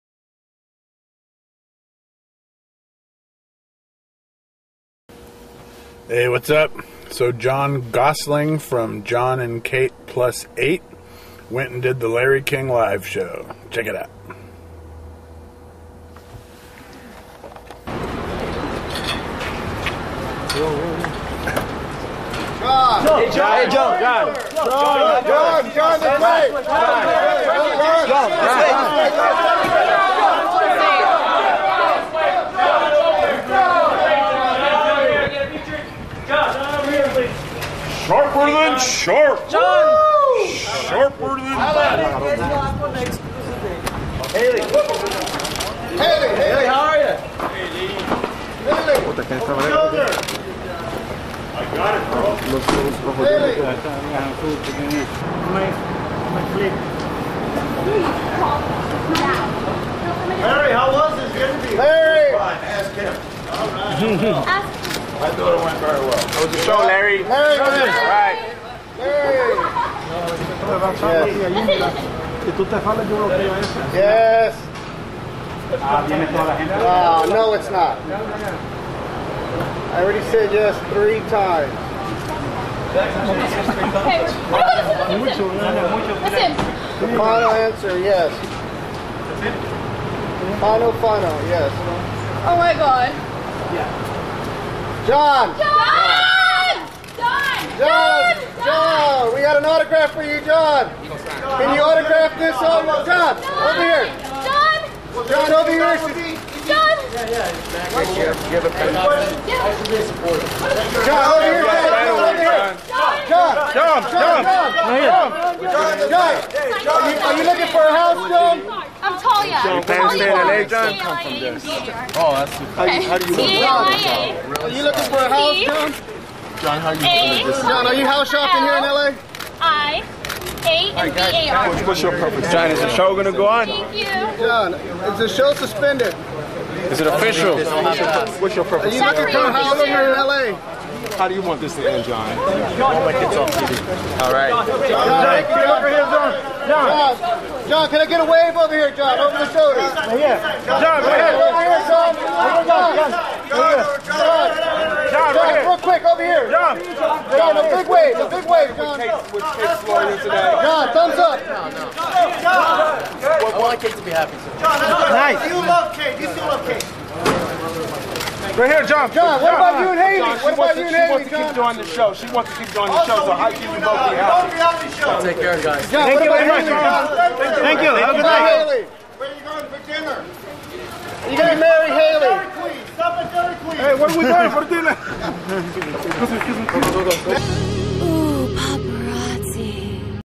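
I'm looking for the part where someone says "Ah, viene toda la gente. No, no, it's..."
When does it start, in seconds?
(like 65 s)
75 s.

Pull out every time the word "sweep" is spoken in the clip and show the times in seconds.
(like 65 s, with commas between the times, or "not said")
not said.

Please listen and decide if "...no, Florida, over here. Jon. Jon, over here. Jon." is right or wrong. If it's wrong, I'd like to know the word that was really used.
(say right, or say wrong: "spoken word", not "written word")
wrong: "Jon", not "Florida".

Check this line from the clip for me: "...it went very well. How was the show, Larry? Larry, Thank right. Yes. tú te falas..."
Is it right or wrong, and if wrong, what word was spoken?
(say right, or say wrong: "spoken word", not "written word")
wrong: "All", not "Thank".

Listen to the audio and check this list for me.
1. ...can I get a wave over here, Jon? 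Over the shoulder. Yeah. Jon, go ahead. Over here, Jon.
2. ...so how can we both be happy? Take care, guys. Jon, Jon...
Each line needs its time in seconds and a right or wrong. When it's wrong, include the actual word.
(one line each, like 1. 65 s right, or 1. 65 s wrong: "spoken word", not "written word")
1. 147 s right
2. 173 s wrong: "Thank", not "Jon".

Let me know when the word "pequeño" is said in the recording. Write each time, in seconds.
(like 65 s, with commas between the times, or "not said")
54 s.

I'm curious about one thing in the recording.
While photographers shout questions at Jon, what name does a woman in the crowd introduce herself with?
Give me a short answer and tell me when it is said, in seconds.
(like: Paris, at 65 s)
Talia, at 119 s.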